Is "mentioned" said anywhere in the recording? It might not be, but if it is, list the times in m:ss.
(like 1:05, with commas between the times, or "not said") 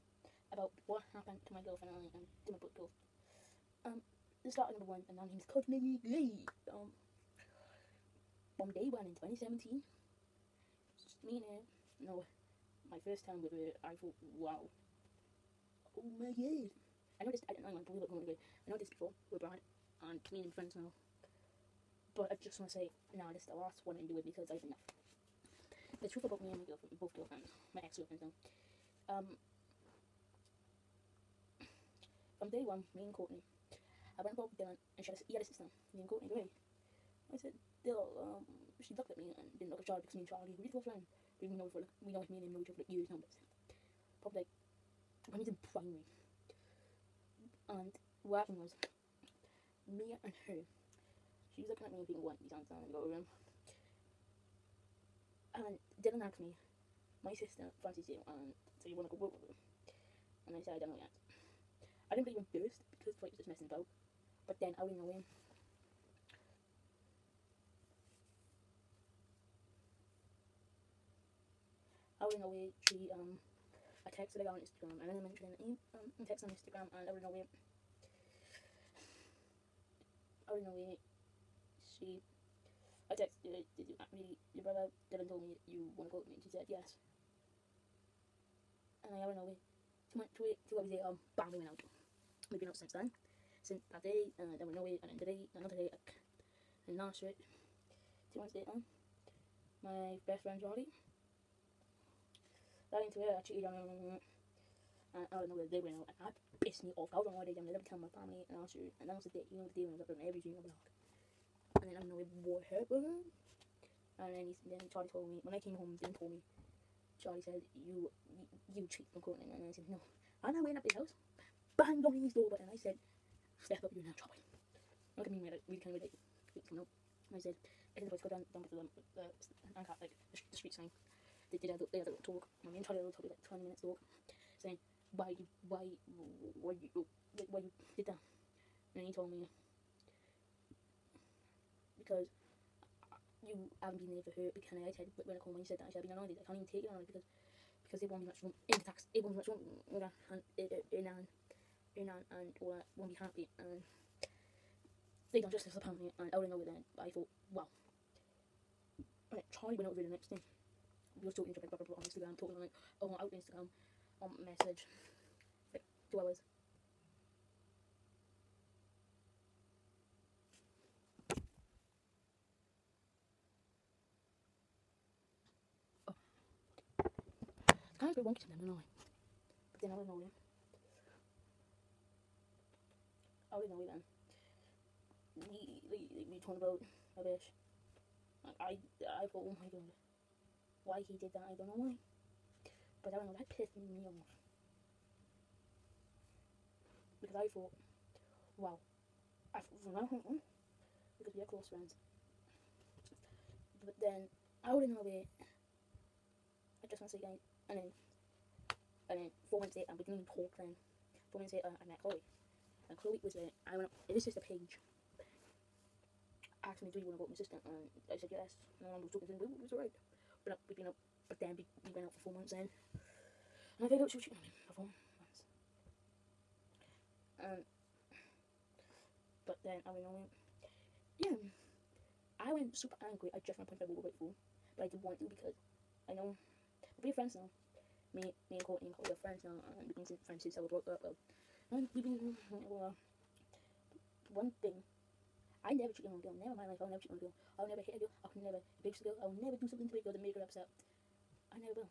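1:15.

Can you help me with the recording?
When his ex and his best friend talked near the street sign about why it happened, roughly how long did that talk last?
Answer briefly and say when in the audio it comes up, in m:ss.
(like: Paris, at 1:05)
20 minutes, at 2:13.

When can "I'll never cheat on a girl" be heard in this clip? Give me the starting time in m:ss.
4:06.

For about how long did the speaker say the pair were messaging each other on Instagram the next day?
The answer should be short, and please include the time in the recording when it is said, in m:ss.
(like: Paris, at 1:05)
2 hours, at 2:46.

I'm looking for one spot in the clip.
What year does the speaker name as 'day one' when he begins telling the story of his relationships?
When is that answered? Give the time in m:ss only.
0:09.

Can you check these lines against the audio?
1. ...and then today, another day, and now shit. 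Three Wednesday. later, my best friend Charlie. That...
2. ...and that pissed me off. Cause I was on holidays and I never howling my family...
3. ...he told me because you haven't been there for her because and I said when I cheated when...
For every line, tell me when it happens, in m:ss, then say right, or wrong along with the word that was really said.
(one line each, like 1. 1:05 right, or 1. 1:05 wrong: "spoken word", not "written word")
1. 1:35 wrong: "Two", not "Three"
2. 1:46 wrong: "telling", not "howling"
3. 2:19 wrong: "called", not "cheated".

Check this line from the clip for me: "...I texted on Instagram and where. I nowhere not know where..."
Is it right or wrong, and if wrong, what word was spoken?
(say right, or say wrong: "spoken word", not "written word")
right.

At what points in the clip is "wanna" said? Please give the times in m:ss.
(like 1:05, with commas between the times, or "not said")
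0:58, 1:25.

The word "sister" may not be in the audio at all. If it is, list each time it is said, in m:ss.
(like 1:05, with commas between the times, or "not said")
0:35, 0:57, 3:37.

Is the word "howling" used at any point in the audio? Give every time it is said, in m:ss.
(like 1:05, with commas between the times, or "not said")
1:12.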